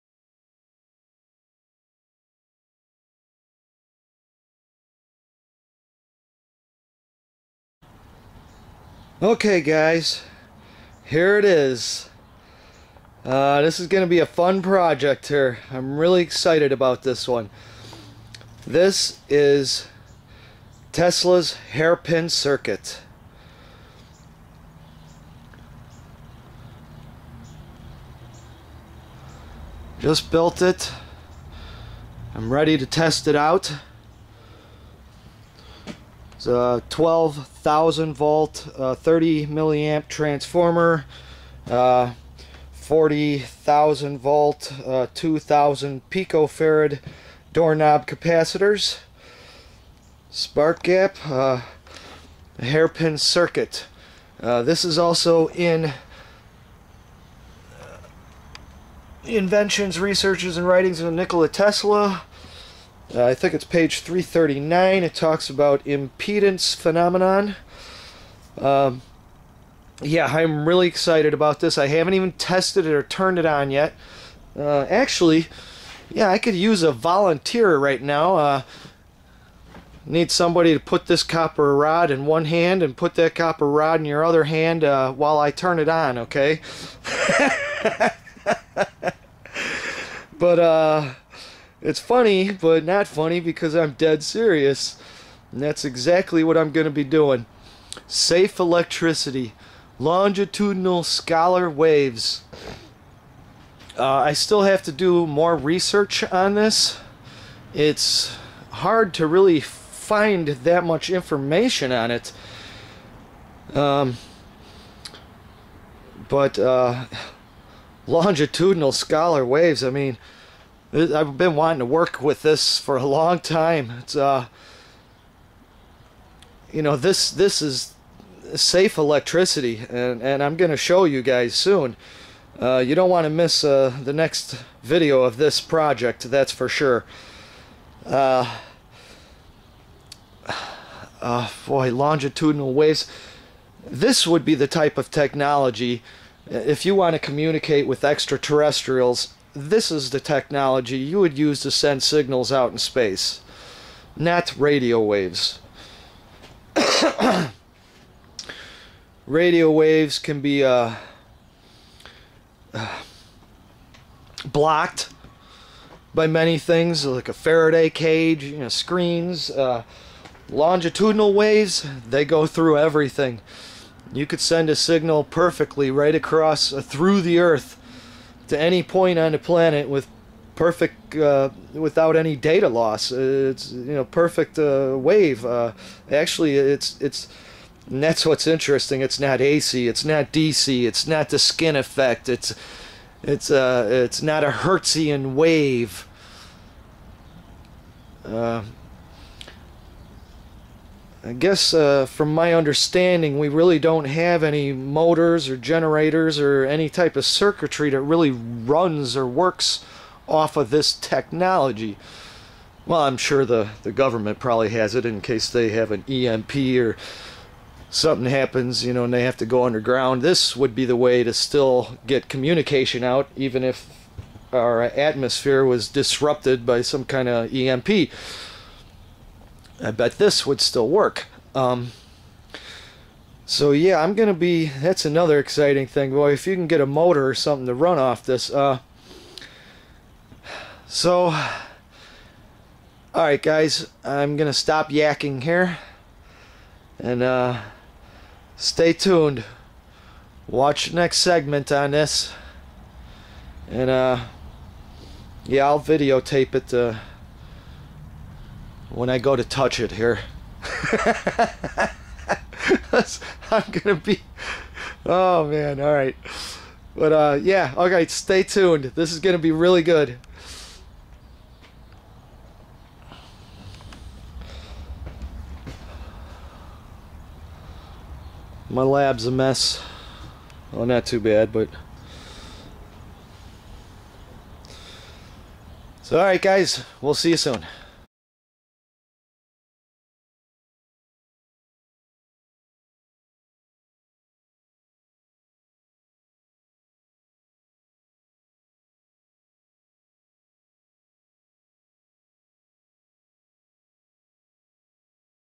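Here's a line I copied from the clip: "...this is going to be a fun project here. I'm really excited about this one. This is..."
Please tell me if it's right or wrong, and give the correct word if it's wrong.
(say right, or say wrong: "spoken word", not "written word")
right.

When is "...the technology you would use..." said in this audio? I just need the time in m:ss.
2:30.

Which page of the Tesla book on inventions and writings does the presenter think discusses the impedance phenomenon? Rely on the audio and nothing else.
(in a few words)
339.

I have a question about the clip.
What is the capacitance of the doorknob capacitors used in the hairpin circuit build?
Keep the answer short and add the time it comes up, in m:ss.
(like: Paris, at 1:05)
2,000 picofarad, at 0:45.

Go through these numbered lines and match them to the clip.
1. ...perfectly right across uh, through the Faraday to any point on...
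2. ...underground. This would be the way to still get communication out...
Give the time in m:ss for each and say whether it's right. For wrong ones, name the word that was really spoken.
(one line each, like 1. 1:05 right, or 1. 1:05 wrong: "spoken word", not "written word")
1. 2:55 wrong: "Earth", not "Faraday"
2. 3:39 right.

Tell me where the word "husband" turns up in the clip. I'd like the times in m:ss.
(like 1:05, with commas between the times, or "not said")
not said.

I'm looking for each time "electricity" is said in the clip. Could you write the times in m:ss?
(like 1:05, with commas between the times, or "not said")
1:38, 2:08.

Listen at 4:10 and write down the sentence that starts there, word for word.
Watch next segment on this, and uh, yeah, I'll videotape it when I go to touch it here.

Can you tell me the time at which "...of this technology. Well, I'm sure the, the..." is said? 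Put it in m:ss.
3:30.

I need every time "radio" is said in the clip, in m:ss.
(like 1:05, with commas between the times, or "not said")
2:34, 2:39.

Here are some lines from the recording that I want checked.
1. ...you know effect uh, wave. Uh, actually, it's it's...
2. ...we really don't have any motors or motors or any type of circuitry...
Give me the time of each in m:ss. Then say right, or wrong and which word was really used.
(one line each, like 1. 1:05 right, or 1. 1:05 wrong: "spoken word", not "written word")
1. 3:03 wrong: "perfect", not "effect"
2. 3:23 wrong: "generators", not "motors".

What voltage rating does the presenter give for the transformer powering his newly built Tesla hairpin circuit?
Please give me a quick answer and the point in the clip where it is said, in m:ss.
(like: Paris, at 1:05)
12,000 volts, at 0:36.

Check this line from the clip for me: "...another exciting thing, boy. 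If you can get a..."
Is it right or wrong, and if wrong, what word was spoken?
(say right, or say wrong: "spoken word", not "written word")
right.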